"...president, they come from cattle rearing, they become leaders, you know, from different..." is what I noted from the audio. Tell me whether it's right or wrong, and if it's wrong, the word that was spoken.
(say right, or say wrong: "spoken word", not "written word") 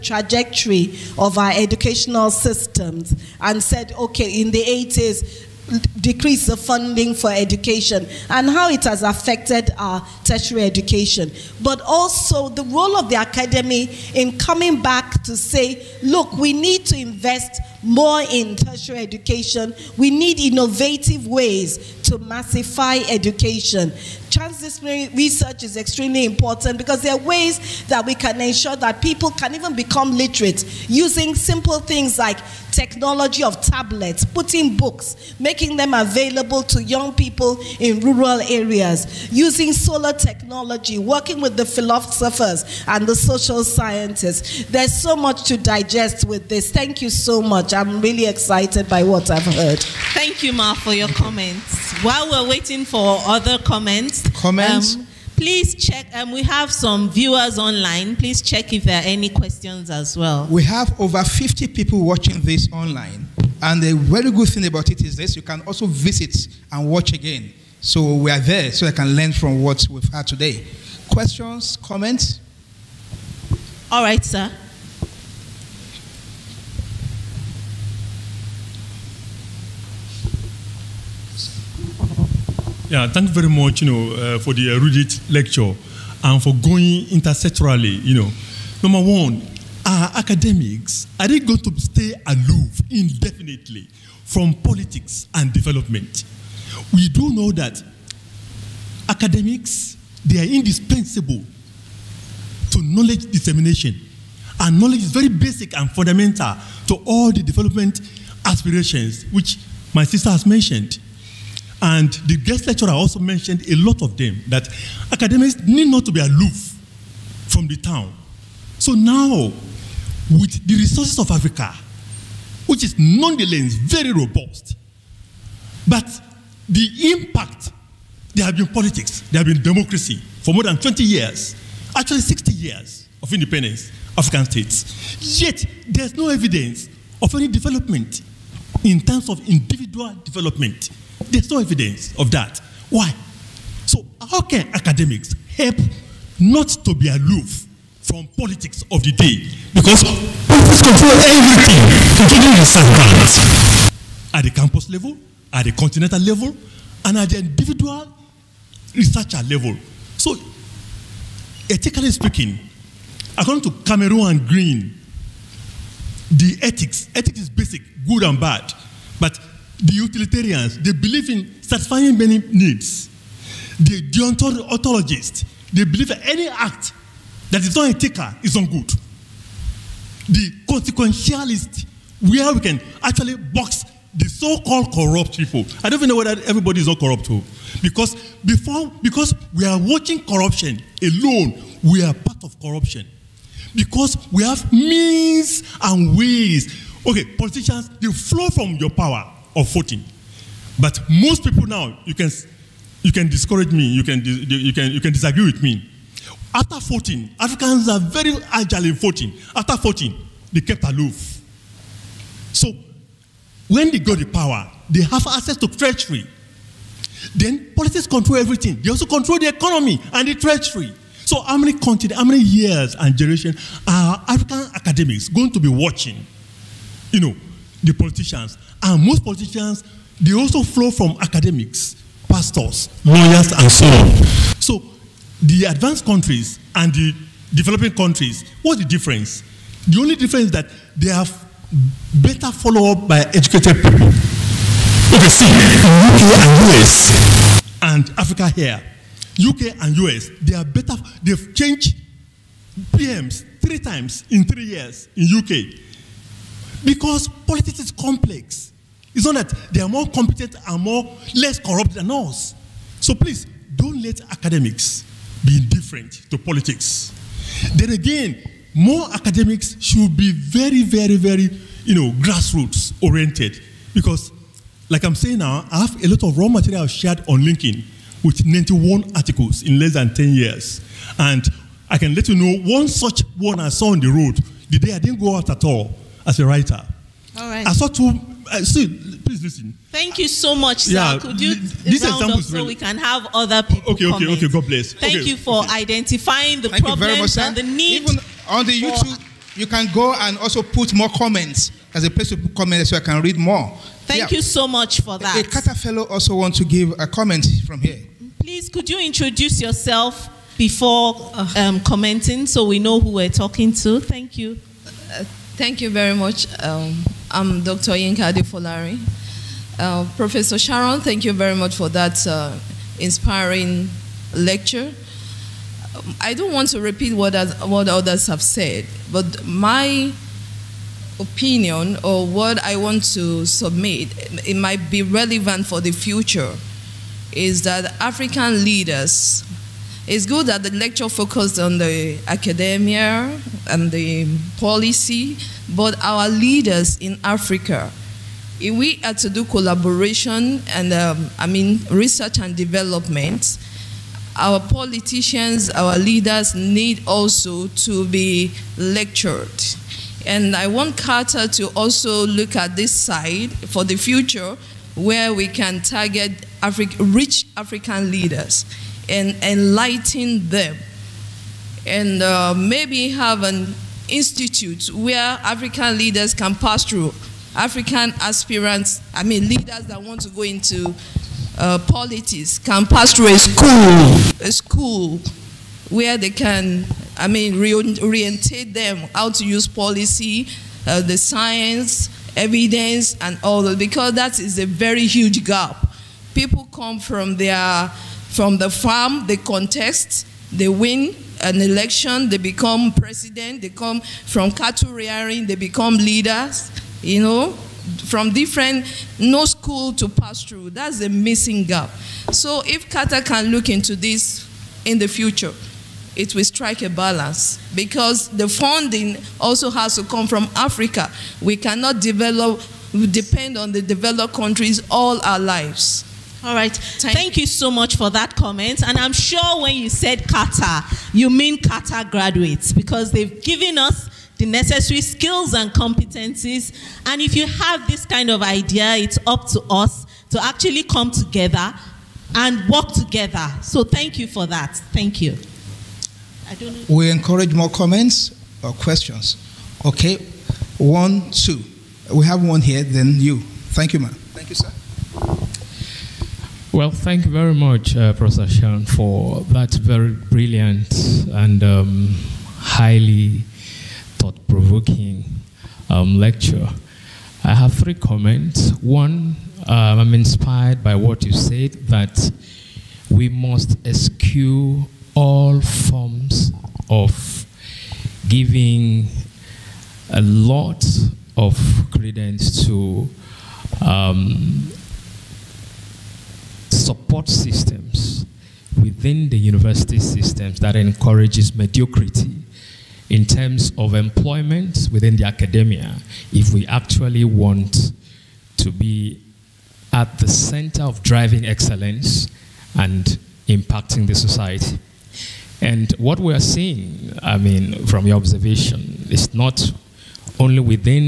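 right.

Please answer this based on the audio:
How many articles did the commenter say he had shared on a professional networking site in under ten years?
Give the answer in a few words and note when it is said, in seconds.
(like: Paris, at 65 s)
91, at 278 s.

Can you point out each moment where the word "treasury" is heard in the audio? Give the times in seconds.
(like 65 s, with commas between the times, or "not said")
215 s, 220 s.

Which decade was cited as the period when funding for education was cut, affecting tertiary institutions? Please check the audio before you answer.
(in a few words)
the 80s.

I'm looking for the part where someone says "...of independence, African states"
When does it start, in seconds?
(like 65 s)
133 s.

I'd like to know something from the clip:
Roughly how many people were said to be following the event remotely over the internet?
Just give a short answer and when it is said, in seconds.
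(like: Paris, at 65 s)
over 50, at 60 s.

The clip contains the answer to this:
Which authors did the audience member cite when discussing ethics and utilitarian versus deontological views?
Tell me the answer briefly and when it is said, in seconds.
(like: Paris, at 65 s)
Cameron and Green, at 163 s.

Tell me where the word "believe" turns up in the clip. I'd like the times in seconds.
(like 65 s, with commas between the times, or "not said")
170 s, 175 s.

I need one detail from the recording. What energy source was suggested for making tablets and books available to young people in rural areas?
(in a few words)
solar technology.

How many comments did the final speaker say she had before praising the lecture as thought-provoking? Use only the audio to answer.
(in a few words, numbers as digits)
3.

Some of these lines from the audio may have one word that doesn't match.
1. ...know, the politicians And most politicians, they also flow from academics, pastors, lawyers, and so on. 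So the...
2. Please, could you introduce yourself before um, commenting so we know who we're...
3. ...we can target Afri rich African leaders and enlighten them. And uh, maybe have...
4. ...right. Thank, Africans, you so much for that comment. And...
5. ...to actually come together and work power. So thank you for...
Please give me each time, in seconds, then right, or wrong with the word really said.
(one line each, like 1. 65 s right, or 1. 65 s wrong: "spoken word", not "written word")
1. 227 s right
2. 308 s right
3. 365 s right
4. 426 s wrong: "Thank", not "Africans"
5. 440 s wrong: "together", not "power".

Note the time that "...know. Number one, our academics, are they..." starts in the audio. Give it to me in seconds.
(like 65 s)
88 s.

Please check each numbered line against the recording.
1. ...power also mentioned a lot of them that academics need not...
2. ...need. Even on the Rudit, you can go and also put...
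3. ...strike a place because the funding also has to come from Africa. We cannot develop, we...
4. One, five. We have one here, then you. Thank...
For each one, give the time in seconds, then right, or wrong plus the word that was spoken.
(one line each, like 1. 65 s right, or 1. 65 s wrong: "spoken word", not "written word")
1. 112 s wrong: "lecturer", not "power"
2. 297 s wrong: "YouTube", not "Rudit"
3. 416 s wrong: "balance", not "place"
4. 450 s wrong: "two", not "five".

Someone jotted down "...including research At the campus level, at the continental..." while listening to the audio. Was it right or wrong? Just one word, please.
right.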